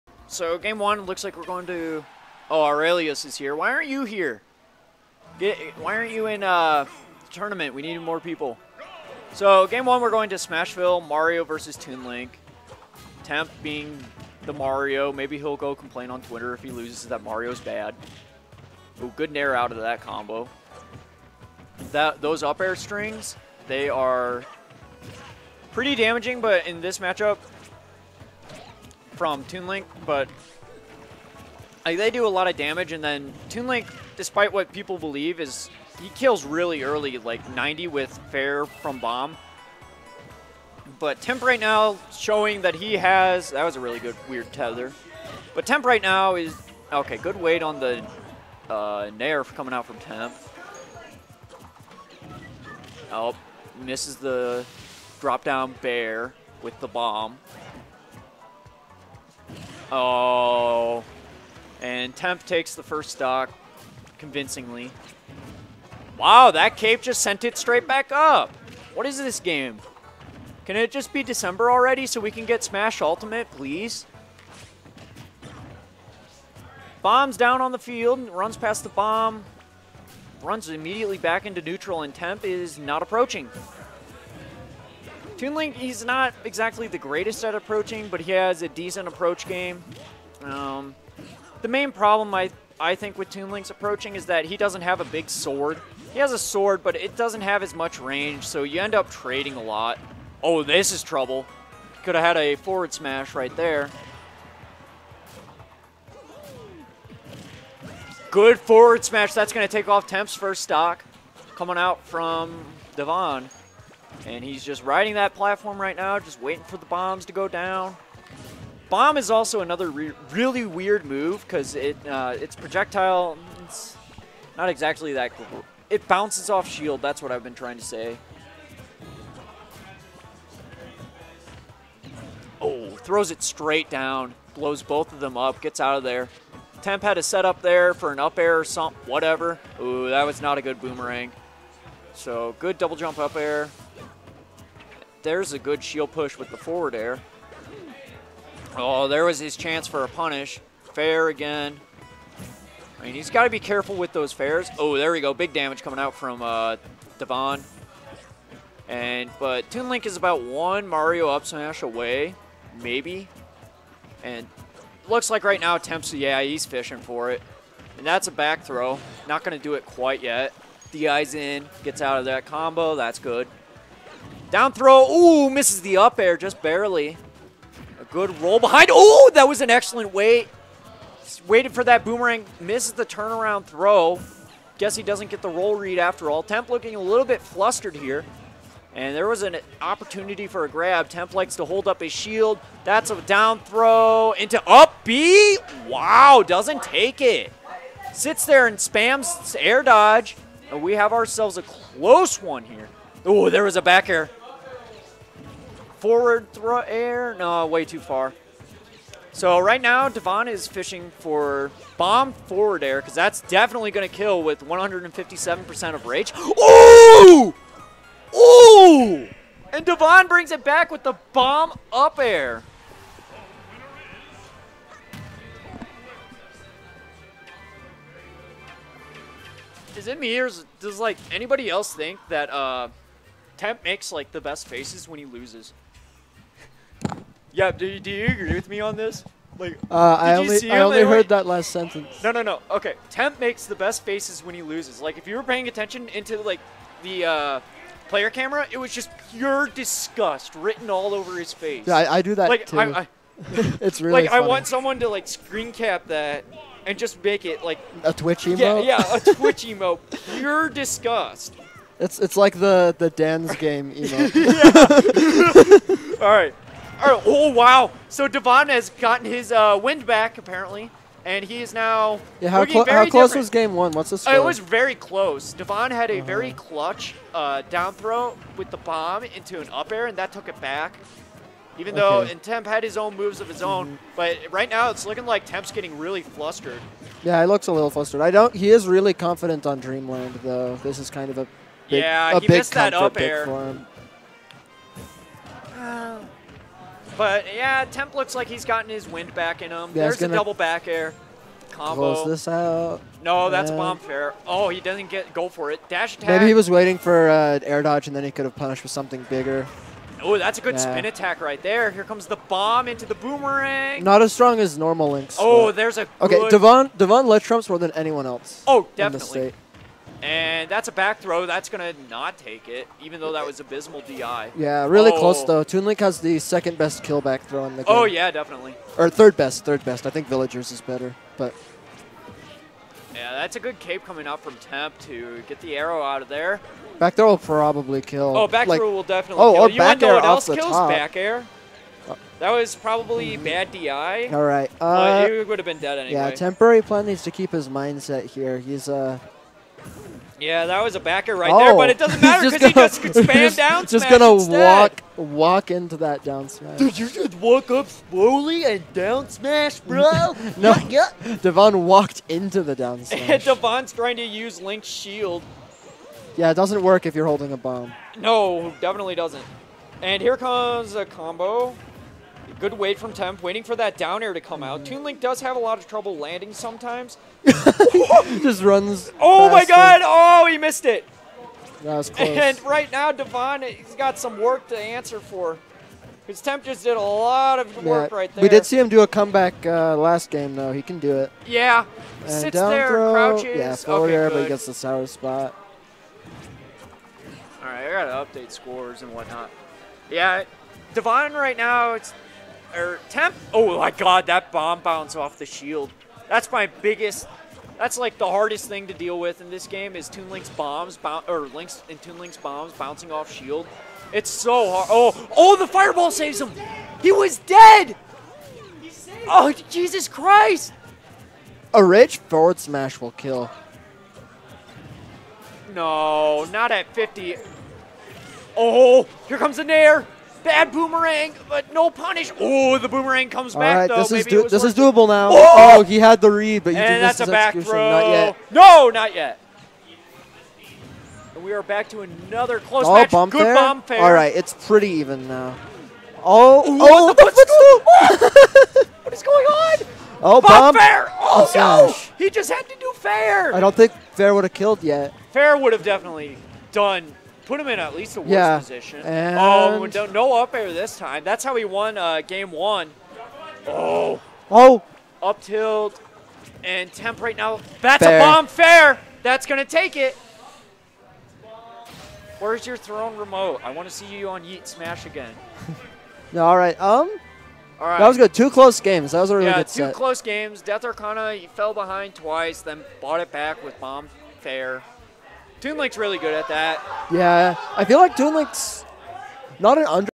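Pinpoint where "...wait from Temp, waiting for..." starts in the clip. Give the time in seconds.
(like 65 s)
372 s.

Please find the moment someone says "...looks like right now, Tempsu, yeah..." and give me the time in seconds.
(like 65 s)
165 s.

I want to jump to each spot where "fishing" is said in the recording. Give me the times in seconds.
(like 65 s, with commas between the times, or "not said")
166 s, 210 s.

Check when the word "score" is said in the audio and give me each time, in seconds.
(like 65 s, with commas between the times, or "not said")
274 s, 398 s.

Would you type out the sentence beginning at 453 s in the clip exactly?
I don't think fair would have killed yet.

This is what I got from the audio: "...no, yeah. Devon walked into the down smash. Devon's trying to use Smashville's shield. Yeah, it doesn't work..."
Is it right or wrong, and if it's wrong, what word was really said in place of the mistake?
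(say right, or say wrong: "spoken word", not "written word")
wrong: "Link", not "Smashville".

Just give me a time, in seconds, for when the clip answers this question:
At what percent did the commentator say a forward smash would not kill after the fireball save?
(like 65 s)
426 s.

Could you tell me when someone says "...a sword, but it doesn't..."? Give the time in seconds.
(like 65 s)
96 s.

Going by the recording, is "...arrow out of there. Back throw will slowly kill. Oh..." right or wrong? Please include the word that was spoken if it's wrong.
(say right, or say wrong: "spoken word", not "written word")
wrong: "probably", not "slowly".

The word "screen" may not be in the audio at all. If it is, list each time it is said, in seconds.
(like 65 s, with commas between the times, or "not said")
255 s.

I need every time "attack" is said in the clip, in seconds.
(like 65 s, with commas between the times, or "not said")
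306 s, 311 s.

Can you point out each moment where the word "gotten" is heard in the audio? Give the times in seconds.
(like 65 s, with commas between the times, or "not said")
268 s, 298 s.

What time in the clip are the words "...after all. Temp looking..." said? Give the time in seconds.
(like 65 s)
185 s.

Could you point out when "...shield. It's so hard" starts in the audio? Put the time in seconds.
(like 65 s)
413 s.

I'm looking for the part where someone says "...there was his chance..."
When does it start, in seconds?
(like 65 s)
149 s.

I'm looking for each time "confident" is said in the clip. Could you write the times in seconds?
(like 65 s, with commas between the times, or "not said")
289 s.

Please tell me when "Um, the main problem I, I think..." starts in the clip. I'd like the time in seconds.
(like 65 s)
90 s.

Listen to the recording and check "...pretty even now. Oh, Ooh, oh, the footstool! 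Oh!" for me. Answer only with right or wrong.
right.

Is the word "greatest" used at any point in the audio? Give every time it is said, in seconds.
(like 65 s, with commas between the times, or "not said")
86 s.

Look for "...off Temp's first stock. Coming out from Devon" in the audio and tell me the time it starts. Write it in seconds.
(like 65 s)
109 s.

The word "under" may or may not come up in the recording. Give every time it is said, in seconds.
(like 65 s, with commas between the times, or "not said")
489 s.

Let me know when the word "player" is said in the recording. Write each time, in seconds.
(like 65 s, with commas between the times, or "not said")
248 s.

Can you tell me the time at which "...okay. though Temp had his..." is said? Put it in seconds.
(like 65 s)
281 s.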